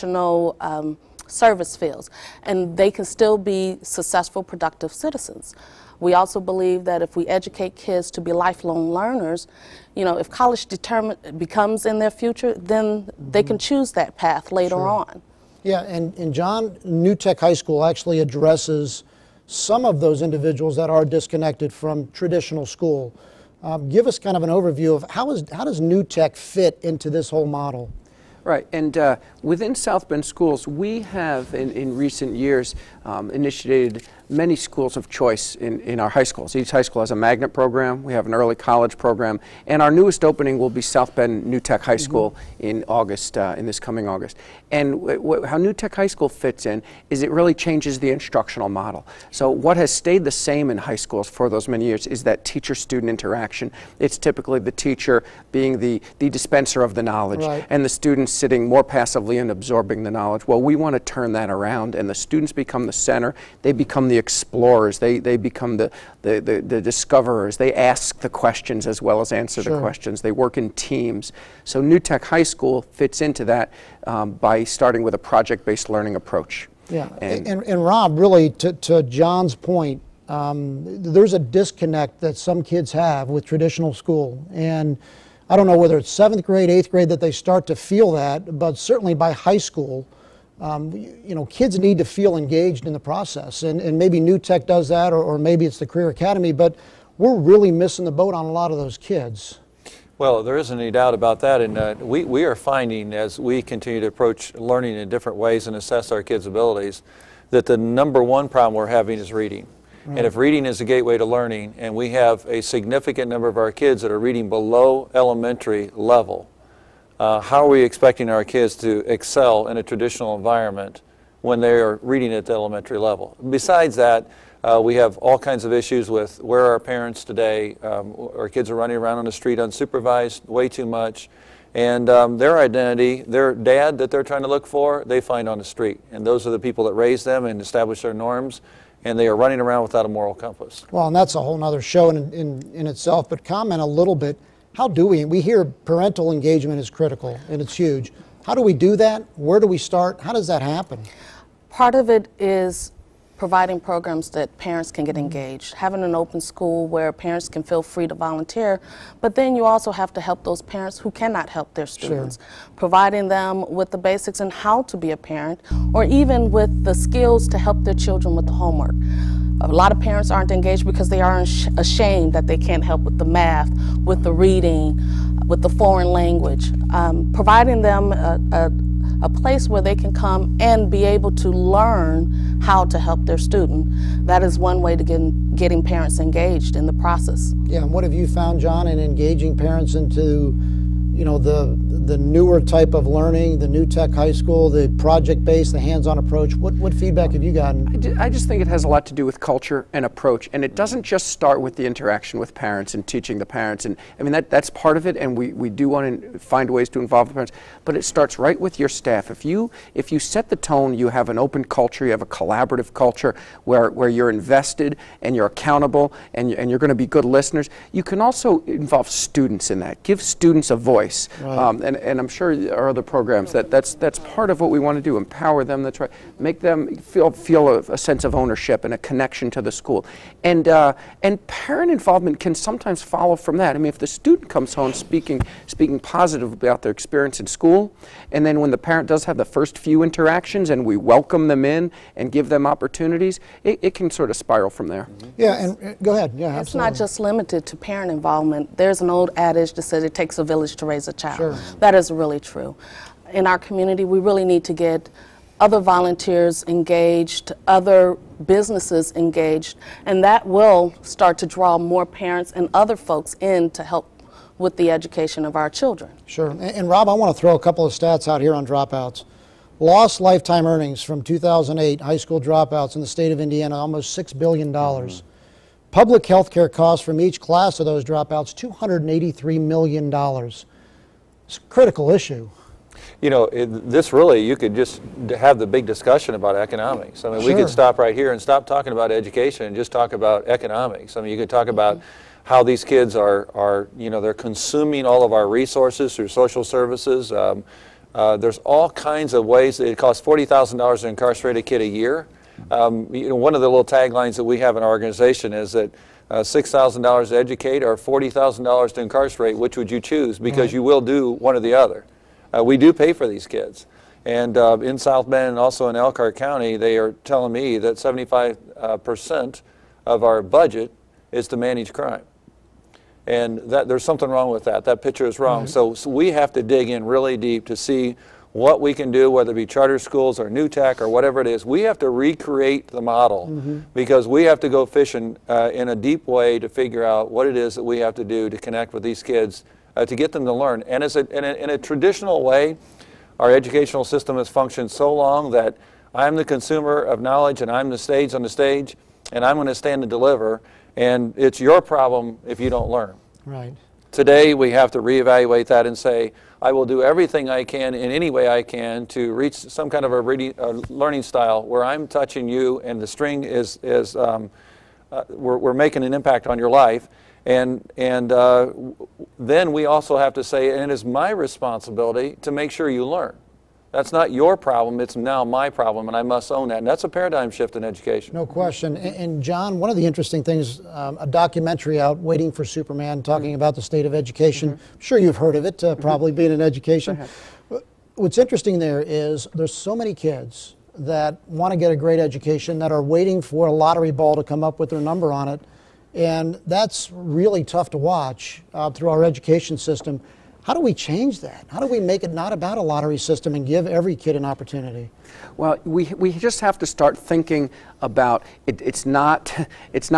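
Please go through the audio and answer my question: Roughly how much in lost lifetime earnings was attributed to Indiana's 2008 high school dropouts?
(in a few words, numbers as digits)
almost $6 billion.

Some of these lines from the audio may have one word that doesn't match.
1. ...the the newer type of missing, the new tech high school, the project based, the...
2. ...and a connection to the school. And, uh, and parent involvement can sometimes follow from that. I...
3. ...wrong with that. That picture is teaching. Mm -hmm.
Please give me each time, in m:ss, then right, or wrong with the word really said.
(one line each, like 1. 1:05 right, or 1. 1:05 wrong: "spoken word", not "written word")
1. 3:11 wrong: "learning", not "missing"
2. 3:48 right
3. 5:24 wrong: "wrong", not "teaching".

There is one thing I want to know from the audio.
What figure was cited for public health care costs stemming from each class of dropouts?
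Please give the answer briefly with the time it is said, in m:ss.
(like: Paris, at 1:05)
$283 million, at 4:38.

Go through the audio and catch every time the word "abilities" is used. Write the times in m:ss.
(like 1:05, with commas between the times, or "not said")
1:46.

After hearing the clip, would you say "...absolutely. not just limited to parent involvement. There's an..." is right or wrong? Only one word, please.
right.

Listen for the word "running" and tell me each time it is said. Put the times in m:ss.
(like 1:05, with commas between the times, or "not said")
2:08, 2:19.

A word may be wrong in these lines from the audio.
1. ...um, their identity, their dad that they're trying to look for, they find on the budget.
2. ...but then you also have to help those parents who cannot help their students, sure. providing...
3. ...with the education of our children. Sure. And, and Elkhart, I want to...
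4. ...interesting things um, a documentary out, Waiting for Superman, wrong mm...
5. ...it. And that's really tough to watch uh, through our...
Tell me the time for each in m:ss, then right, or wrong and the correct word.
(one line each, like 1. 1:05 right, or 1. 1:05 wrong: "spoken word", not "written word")
1. 2:12 wrong: "street", not "budget"
2. 2:39 right
3. 4:24 wrong: "Rob", not "Elkhart"
4. 6:20 wrong: "talking", not "wrong"
5. 6:35 right.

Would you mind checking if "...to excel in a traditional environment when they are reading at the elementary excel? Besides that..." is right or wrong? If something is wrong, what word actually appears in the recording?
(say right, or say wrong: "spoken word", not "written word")
wrong: "level", not "excel".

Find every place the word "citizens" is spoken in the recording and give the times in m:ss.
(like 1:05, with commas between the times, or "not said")
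0:04.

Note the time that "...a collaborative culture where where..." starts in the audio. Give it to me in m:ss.
3:32.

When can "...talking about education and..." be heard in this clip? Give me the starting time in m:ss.
4:48.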